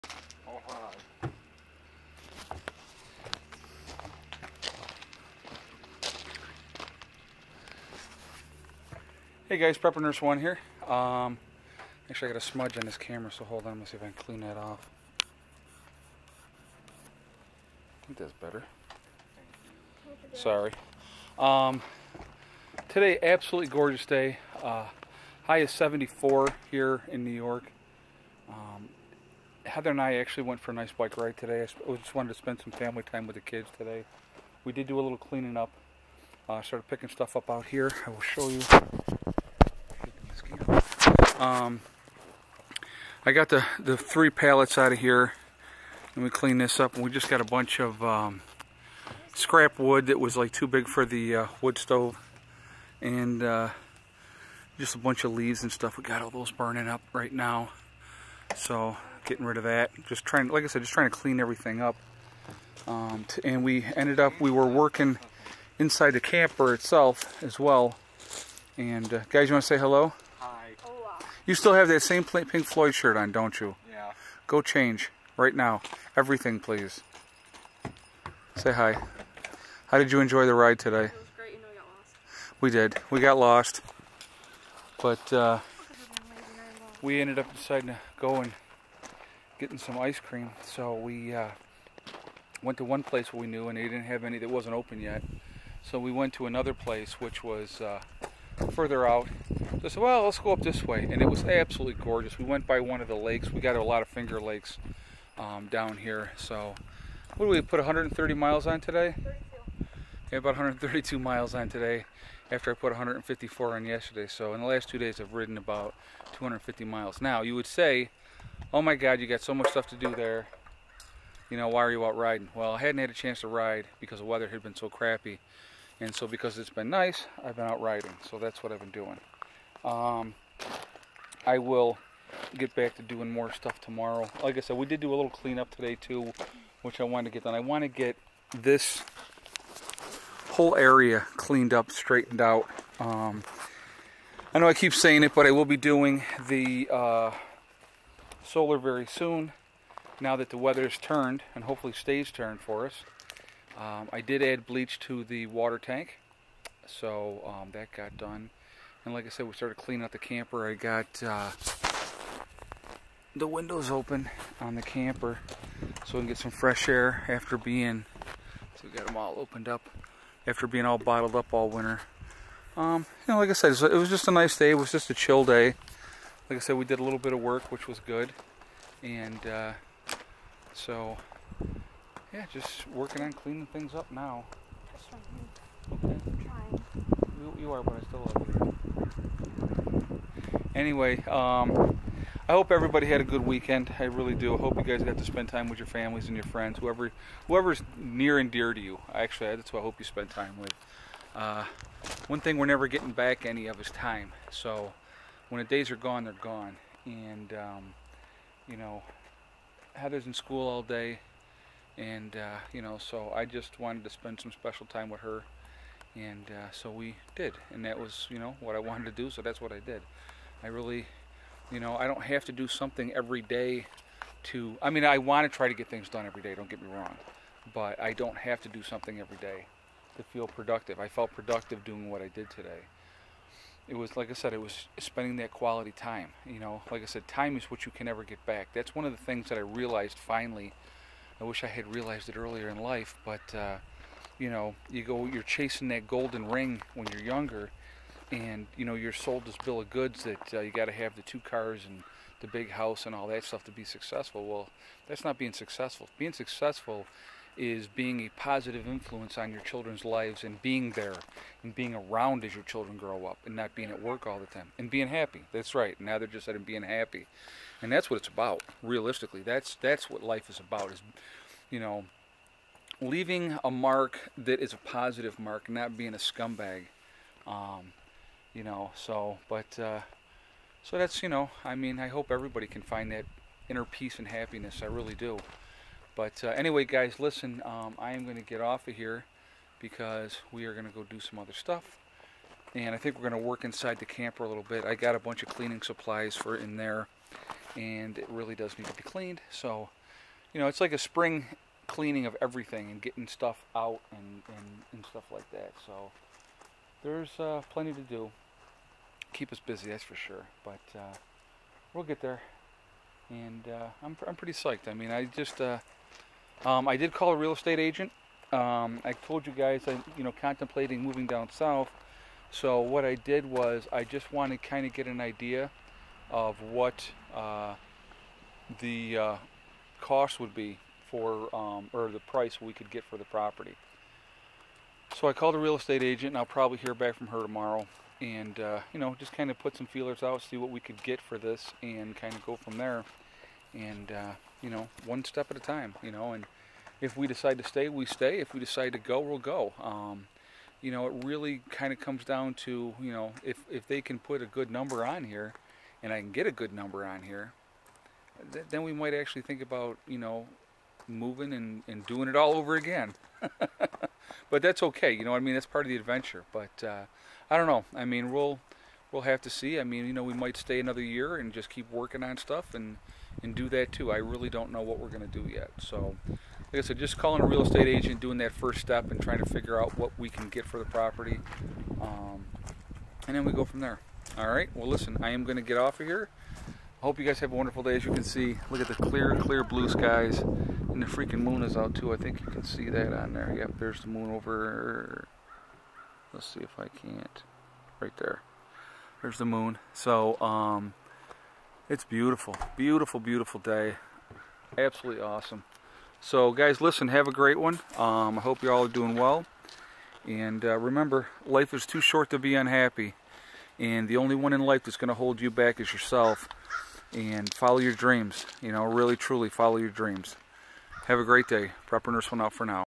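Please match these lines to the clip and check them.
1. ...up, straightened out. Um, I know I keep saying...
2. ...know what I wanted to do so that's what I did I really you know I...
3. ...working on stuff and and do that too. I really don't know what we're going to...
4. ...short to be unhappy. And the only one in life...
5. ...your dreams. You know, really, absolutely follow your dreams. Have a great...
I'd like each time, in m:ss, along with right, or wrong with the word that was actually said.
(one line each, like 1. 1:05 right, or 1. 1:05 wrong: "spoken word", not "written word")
1. 2:21 right
2. 3:38 right
3. 6:11 right
4. 6:51 right
5. 6:57 wrong: "truly", not "absolutely".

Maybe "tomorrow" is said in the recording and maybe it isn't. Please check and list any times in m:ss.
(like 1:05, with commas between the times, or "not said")
2:13, 5:37.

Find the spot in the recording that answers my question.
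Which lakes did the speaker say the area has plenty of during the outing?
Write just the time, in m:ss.
1:44.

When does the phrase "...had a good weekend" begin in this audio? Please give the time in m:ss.
3:13.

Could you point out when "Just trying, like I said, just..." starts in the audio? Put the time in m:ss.
1:00.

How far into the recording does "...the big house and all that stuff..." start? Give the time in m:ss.
4:12.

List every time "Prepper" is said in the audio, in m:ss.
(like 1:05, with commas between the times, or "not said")
0:09, 7:01.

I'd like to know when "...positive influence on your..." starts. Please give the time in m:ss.
4:18.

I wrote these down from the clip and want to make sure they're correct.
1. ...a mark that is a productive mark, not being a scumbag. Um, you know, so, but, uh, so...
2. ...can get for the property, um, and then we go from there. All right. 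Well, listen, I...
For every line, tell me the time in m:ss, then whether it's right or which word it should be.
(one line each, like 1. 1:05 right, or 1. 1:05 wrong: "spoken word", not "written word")
1. 4:33 wrong: "positive", not "productive"
2. 6:20 right.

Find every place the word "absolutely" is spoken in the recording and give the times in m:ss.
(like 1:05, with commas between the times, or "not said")
0:23, 1:41, 6:44.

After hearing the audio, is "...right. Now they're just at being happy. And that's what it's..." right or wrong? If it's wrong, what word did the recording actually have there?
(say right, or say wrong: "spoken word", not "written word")
right.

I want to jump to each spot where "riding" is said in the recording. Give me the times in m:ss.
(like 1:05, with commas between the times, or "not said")
2:02, 2:07.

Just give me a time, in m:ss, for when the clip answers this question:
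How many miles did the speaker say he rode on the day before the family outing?
1:52.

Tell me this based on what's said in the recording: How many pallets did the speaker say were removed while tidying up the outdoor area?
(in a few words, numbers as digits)
3.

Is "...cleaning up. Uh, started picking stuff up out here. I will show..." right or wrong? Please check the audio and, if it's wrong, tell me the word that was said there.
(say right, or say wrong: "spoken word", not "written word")
right.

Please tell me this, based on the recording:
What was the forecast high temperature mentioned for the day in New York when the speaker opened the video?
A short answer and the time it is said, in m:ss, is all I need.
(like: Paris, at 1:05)
74, at 0:25.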